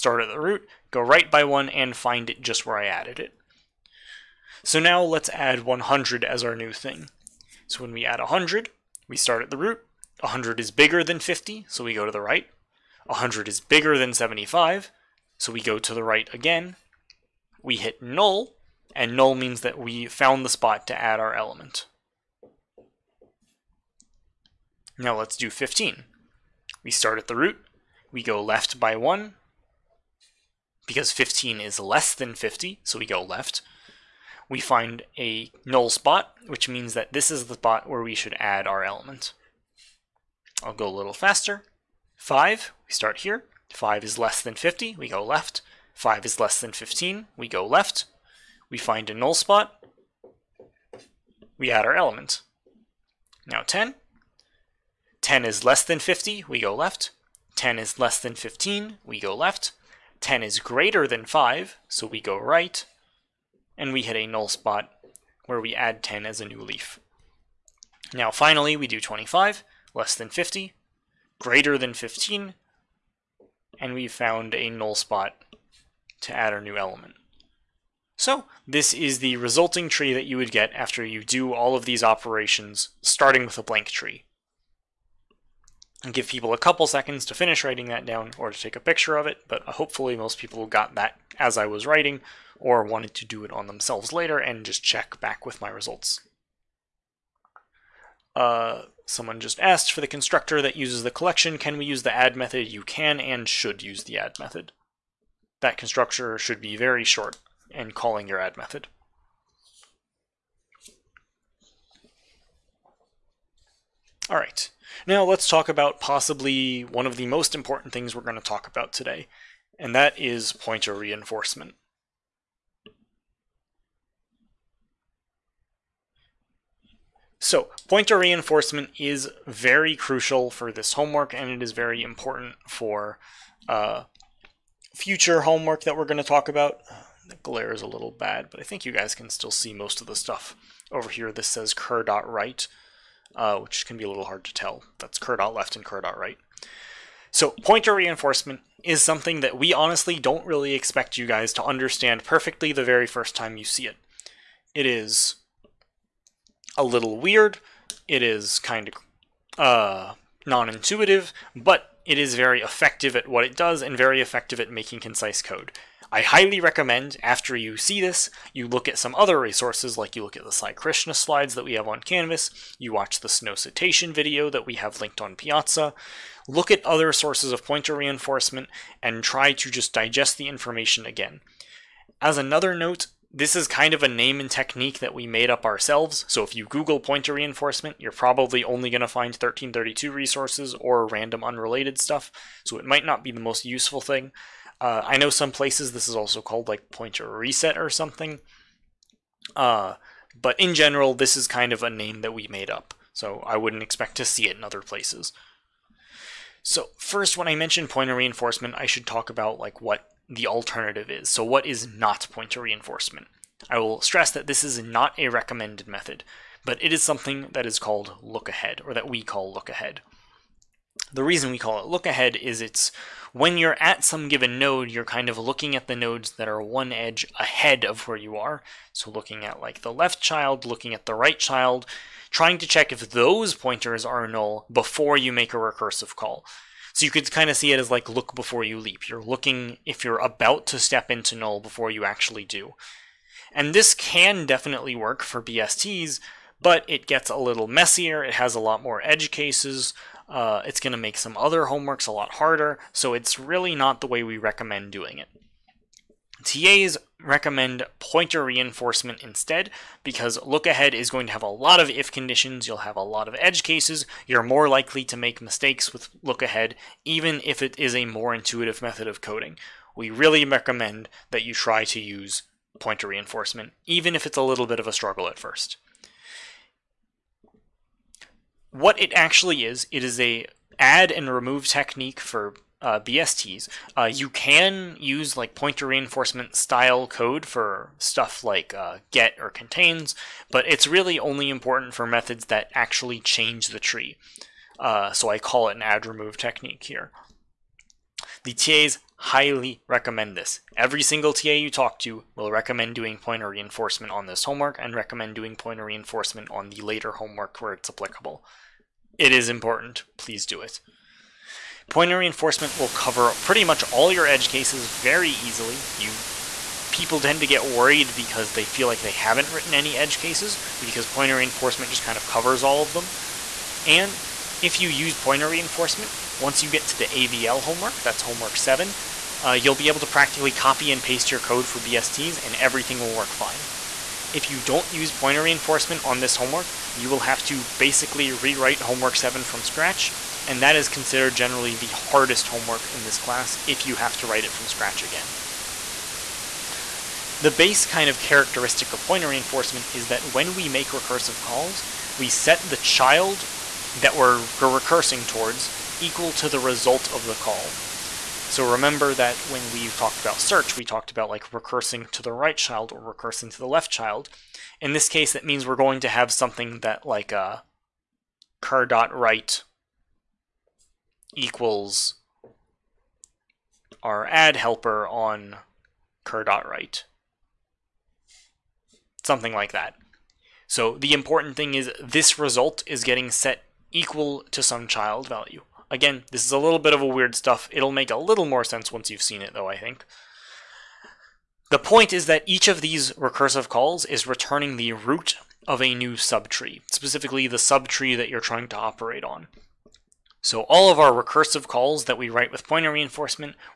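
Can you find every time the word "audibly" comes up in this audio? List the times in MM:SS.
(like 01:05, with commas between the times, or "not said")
not said.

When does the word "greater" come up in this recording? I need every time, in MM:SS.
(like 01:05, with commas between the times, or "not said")
01:00, 01:11.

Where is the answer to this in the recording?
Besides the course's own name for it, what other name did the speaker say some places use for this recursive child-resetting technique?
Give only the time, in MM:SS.
03:16.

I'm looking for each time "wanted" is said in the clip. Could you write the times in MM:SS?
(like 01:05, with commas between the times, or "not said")
01:32.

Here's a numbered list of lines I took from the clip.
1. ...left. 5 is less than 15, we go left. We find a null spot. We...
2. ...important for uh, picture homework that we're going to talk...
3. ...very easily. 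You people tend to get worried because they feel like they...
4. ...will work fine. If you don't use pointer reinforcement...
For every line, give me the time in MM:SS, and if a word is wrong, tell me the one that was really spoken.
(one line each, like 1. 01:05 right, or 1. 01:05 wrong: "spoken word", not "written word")
1. 00:45 right
2. 02:12 wrong: "future", not "picture"
3. 05:14 right
4. 05:32 right.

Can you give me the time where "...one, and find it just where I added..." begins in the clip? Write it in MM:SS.
00:01.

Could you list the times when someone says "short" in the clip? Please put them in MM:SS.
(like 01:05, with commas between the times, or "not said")
01:47.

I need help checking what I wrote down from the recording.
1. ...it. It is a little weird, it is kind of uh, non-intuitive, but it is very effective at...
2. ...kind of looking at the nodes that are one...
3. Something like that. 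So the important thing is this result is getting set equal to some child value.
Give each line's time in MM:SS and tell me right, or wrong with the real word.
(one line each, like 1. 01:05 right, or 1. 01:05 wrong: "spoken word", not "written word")
1. 02:33 right
2. 03:45 right
3. 06:19 right.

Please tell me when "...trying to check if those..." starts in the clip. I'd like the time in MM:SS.
03:52.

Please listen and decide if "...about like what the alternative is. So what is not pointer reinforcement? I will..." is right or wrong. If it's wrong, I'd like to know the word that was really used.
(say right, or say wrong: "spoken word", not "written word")
right.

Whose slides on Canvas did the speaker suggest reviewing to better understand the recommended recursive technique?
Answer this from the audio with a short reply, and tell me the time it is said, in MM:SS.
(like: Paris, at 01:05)
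Sai Krishna, at 02:50.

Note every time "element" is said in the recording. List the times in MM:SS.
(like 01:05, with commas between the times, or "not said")
00:21, 00:38, 00:51, 01:16.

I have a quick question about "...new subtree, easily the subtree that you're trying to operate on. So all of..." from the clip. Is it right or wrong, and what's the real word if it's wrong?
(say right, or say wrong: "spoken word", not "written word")
wrong: "specifically", not "easily".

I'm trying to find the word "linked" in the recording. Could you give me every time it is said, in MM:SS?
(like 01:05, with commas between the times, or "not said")
02:55.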